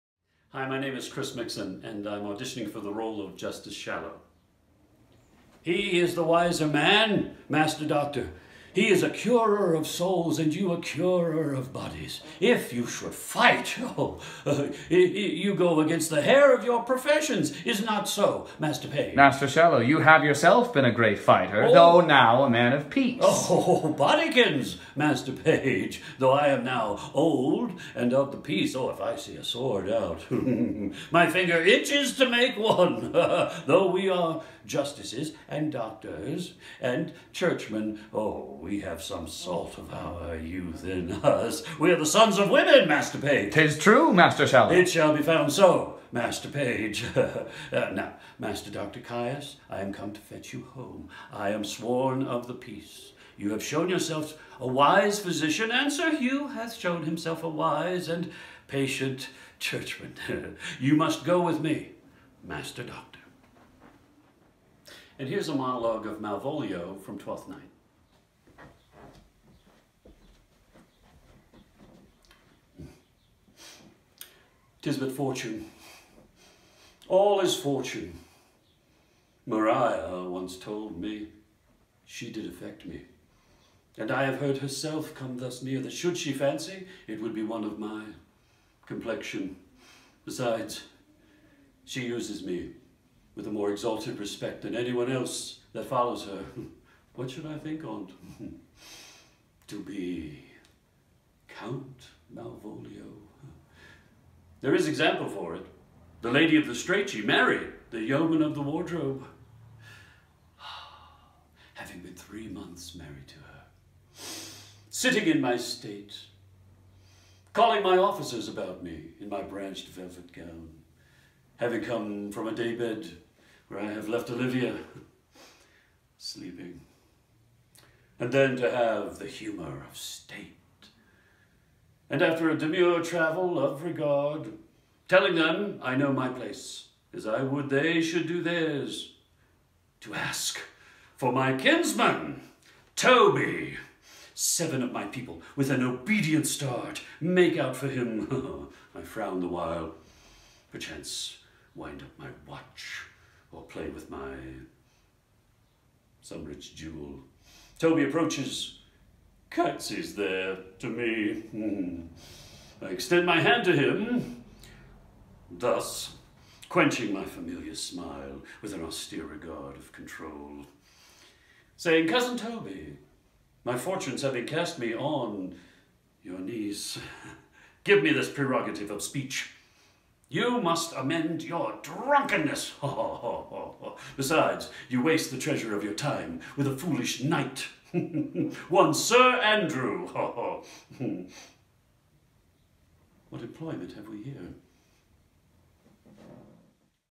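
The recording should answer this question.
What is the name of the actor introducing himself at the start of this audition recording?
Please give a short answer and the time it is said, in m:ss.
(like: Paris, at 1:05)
Chris Mixon, at 0:01.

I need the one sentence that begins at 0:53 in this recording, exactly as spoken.
You have shown yourself a wise physician, and Sir Hugh hath shown himself a wise and patient churchman.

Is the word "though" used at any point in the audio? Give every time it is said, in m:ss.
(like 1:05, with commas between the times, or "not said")
0:21, 0:26, 0:33.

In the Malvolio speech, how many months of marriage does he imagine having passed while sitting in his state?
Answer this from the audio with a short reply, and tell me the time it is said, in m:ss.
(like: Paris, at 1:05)
3, at 1:52.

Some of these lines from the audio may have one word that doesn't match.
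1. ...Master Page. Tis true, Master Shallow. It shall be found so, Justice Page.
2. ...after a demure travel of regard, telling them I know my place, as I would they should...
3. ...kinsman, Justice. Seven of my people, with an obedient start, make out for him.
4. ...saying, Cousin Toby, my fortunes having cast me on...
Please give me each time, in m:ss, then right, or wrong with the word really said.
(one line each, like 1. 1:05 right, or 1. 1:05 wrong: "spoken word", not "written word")
1. 0:42 wrong: "Master", not "Justice"
2. 2:12 right
3. 2:21 wrong: "Toby", not "Justice"
4. 2:51 right.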